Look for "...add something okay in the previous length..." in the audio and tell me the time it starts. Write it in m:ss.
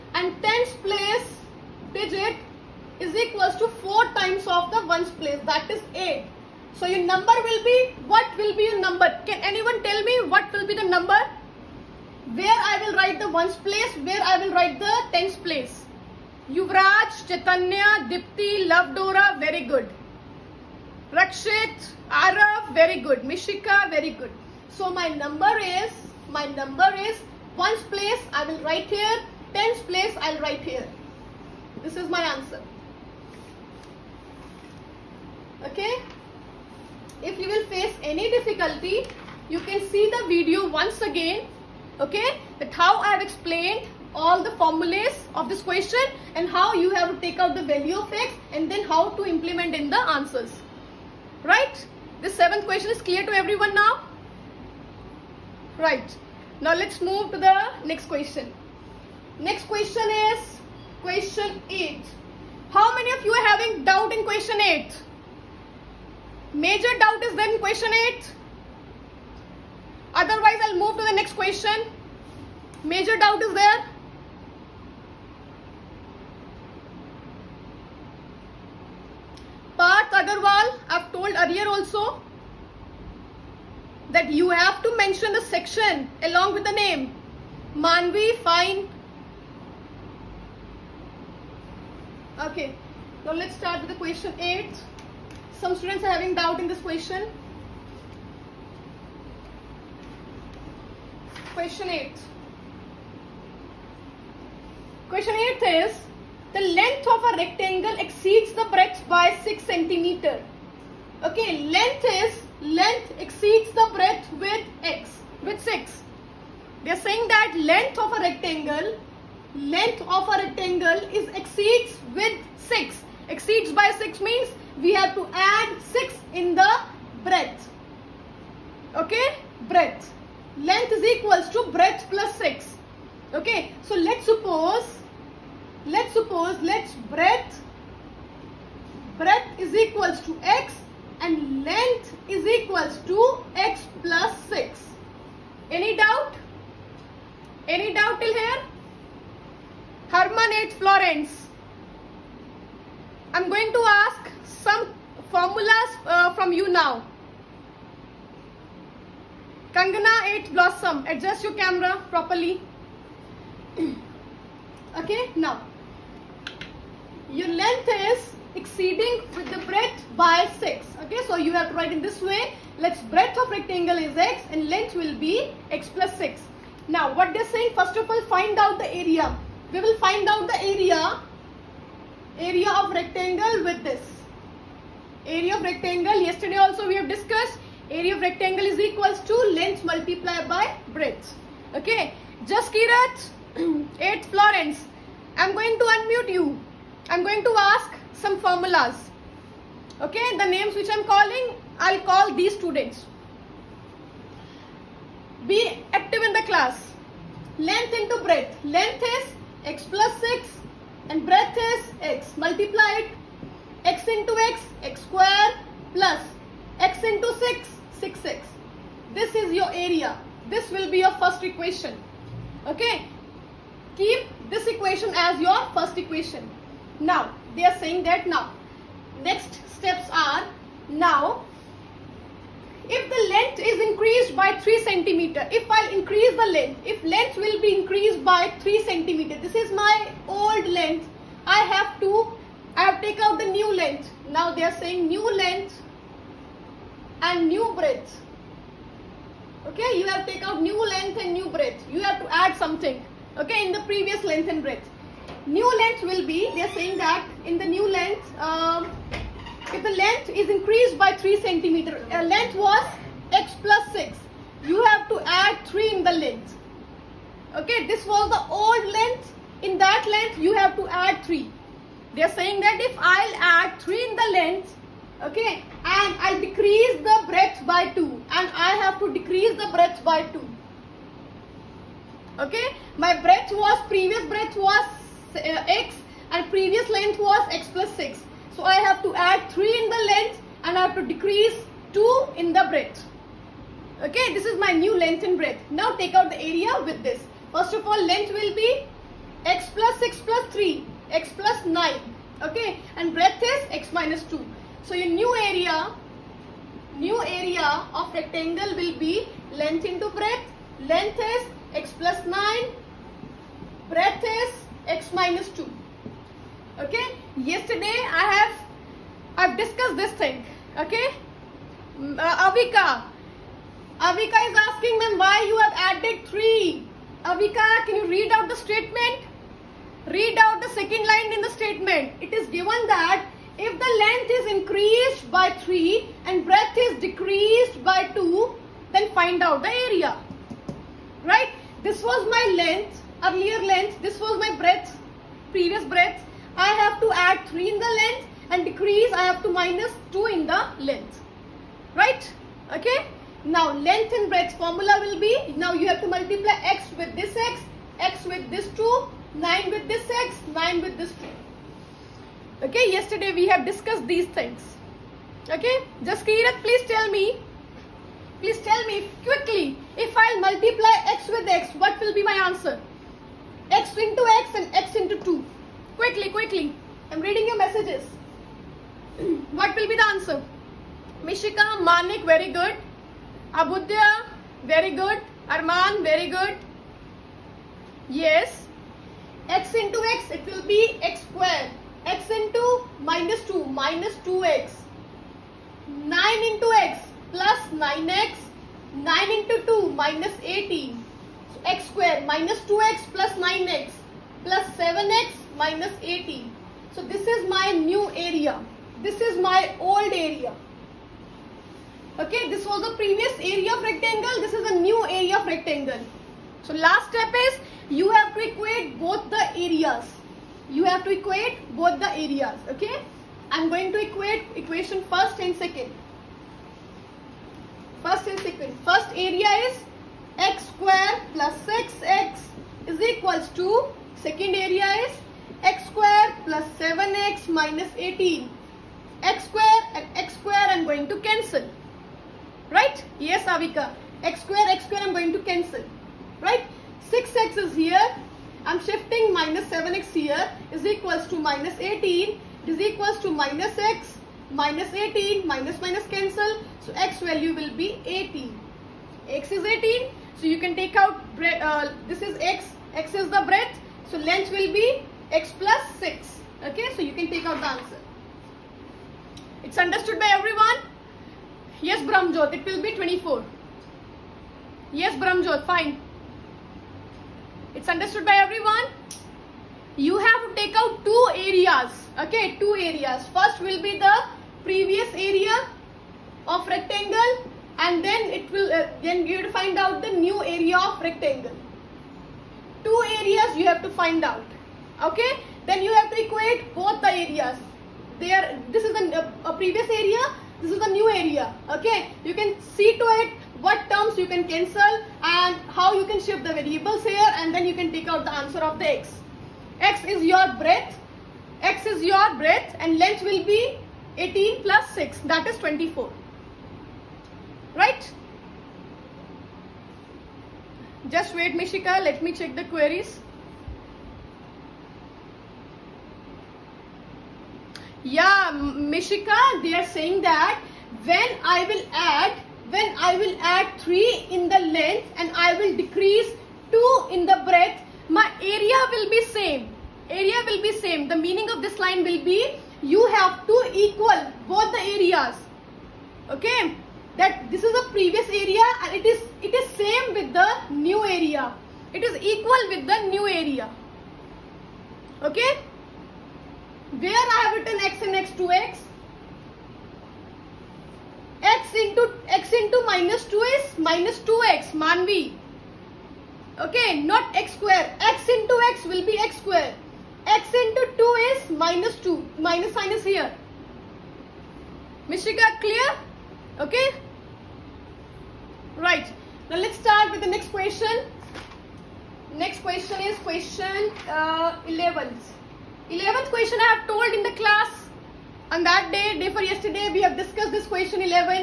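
4:12.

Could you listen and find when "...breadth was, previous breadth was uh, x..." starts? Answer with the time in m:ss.
4:43.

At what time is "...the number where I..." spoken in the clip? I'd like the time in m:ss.
0:10.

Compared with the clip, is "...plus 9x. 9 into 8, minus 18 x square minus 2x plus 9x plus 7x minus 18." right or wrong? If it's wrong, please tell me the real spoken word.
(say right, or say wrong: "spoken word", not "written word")
wrong: "2", not "8".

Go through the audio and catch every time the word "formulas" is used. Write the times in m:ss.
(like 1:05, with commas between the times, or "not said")
0:44, 2:35, 3:18, 5:54.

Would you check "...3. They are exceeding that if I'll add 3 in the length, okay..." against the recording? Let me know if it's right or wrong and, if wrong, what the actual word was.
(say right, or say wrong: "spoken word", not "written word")
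wrong: "saying", not "exceeding".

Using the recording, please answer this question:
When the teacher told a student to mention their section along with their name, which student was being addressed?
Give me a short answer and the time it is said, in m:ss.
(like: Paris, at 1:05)
Parth Agarwal, at 1:19.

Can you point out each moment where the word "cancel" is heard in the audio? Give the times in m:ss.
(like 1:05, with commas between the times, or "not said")
7:21, 7:25, 7:36, 8:24.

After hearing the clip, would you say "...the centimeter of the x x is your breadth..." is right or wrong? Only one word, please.
wrong.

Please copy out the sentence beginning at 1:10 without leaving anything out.
Otherwise, I'll move to the next question.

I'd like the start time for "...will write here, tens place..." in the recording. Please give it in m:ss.
0:28.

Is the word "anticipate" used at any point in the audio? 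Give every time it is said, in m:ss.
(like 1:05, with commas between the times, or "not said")
not said.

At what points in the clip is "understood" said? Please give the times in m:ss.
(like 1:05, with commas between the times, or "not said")
7:49, 7:57.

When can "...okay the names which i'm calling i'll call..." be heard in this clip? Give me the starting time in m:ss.
3:19.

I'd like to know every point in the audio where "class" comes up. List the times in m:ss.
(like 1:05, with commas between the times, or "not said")
3:26, 9:47.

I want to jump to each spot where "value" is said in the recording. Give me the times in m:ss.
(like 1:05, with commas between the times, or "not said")
0:47, 7:37.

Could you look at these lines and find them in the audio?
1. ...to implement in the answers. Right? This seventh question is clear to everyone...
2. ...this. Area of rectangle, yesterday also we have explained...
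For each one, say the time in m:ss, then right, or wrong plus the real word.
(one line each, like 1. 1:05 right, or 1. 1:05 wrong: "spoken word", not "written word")
1. 0:49 right
2. 3:03 wrong: "discussed", not "explained".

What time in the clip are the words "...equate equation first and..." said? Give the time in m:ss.
7:04.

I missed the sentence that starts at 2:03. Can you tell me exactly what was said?
Exceeds by 6 means we have to add 6 in the breadth.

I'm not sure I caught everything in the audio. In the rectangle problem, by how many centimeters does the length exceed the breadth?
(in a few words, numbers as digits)
6.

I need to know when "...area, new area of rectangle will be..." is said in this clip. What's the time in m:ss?
5:05.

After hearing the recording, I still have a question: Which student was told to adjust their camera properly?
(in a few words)
Kangana.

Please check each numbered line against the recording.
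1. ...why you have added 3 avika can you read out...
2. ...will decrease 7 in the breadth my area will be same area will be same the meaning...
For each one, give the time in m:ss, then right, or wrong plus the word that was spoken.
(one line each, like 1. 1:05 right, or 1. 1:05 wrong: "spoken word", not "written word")
1. 5:25 right
2. 8:55 wrong: "2", not "7".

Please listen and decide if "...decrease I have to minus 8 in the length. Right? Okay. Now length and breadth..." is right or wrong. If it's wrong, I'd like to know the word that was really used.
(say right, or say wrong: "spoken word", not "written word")
wrong: "2", not "8".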